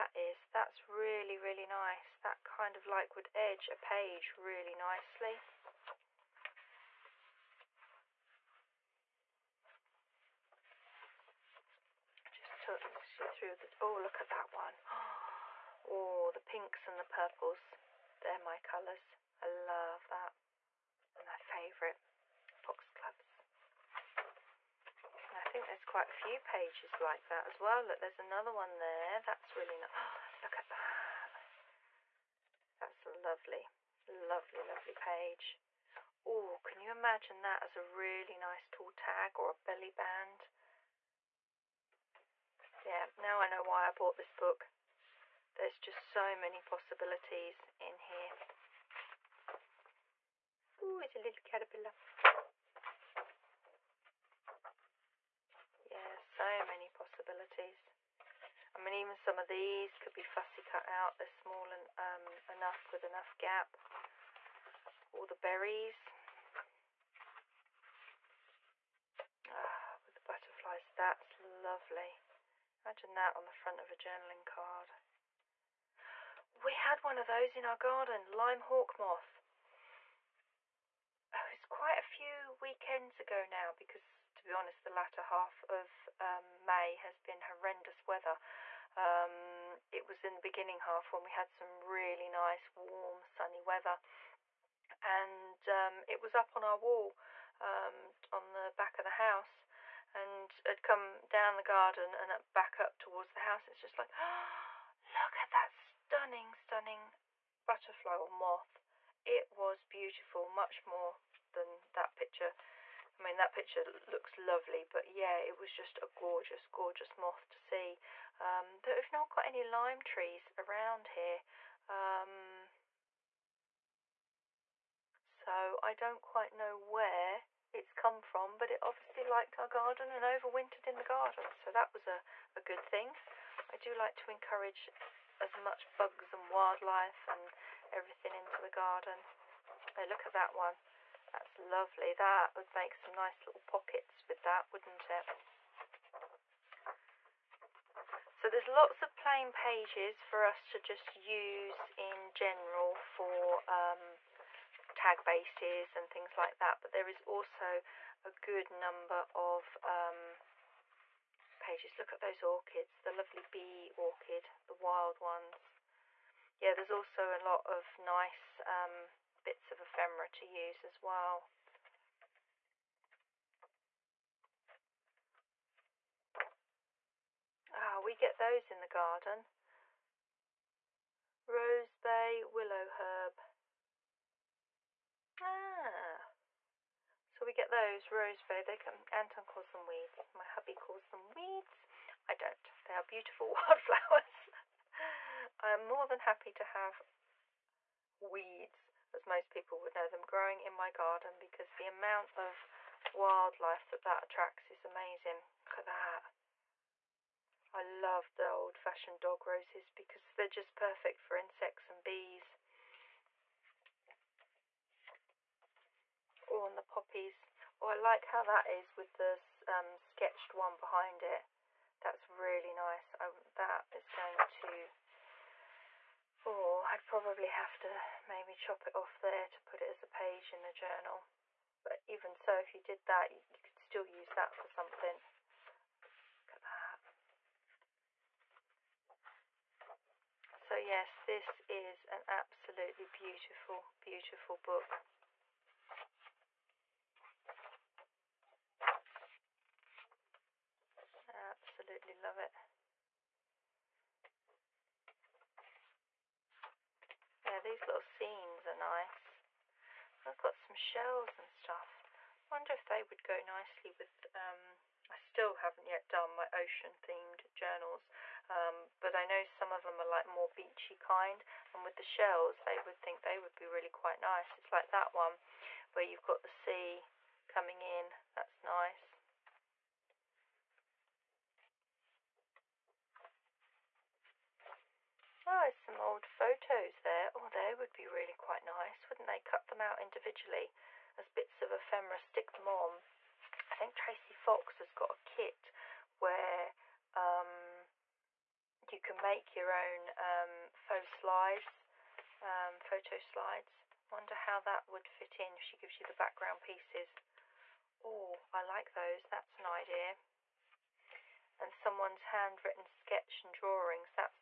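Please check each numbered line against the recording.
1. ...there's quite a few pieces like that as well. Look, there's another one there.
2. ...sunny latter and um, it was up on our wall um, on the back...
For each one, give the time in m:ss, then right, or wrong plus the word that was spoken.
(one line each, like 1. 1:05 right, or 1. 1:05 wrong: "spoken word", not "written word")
1. 0:25 wrong: "pages", not "pieces"
2. 1:33 wrong: "weather", not "latter".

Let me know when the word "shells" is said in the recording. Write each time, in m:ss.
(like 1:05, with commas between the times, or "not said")
4:20, 4:32.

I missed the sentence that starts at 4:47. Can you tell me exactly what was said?
Oh, they would be really quite nice, wouldn't they?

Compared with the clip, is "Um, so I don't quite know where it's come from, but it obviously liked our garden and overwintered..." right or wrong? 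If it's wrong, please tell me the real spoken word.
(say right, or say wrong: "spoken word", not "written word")
right.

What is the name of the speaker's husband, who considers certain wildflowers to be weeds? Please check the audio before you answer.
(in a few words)
Anton.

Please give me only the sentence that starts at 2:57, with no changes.
Ah, we get those in the garden.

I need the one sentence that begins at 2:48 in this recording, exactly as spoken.
Um, bits of ephemera to use as well.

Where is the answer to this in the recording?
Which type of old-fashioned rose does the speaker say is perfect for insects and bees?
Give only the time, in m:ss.
3:29.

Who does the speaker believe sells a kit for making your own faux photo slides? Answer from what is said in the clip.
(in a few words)
Tracy Fox.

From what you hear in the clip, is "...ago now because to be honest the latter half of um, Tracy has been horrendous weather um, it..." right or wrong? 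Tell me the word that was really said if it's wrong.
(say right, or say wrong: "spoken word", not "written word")
wrong: "May", not "Tracy".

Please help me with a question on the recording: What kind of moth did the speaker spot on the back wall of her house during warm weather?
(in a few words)
Lime hawk moth.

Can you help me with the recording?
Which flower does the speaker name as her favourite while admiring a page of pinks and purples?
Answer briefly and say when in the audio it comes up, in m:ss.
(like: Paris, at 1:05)
Foxgloves, at 0:22.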